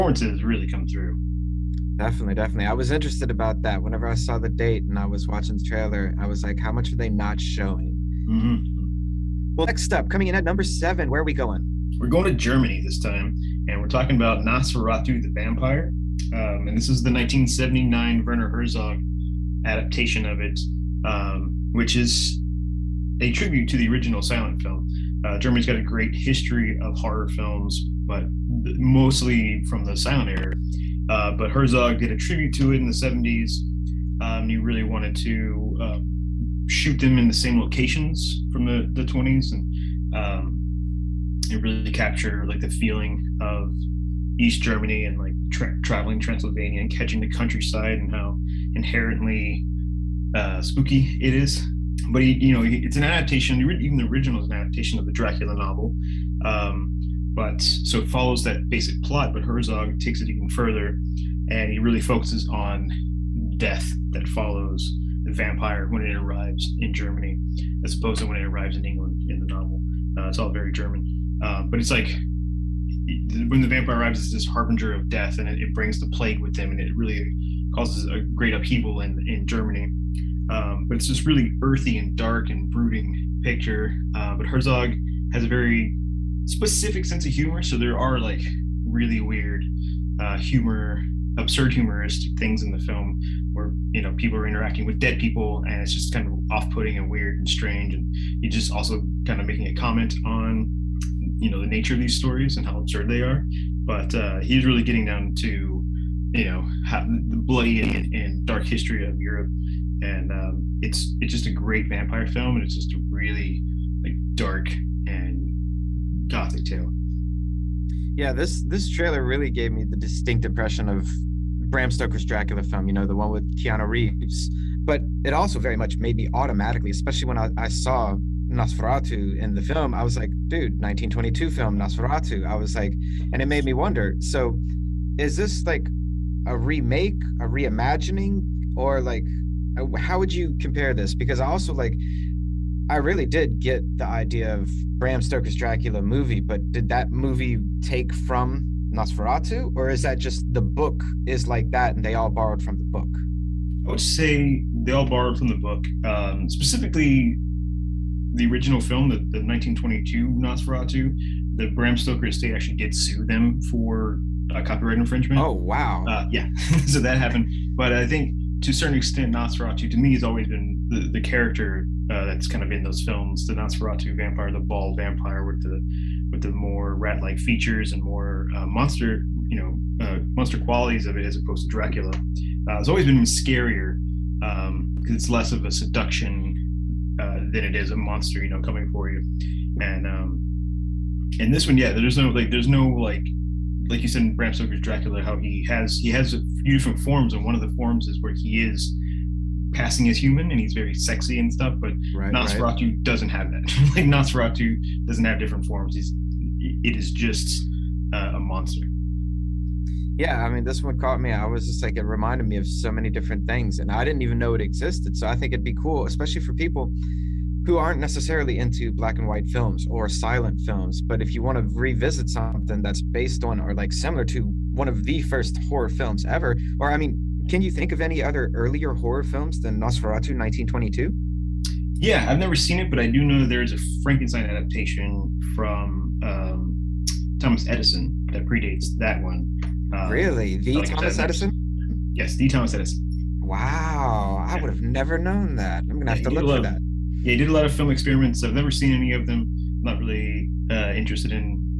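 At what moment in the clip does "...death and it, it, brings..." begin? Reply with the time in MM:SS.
01:15.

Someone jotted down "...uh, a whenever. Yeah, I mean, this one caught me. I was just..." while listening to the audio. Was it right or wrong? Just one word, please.
wrong.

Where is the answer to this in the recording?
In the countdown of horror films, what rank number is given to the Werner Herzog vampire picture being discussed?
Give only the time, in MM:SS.
00:10.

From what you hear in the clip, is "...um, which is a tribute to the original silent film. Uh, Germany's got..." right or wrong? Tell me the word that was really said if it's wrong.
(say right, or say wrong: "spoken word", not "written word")
right.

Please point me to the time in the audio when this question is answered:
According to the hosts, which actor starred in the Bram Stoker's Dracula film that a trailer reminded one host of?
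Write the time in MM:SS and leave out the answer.
02:03.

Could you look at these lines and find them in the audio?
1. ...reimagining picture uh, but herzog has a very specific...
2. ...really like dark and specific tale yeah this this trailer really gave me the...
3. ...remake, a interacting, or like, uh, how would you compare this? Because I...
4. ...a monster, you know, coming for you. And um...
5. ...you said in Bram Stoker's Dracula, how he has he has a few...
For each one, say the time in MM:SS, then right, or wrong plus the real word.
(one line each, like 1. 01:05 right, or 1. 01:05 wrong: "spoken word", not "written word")
1. 01:22 wrong: "brooding", not "reimagining"
2. 01:53 wrong: "gothic", not "specific"
3. 02:16 wrong: "reimagining", not "interacting"
4. 03:07 right
5. 03:14 right.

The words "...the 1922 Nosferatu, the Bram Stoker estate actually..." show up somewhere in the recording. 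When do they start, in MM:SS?
02:39.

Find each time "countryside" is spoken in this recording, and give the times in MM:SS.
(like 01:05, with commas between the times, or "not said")
00:47.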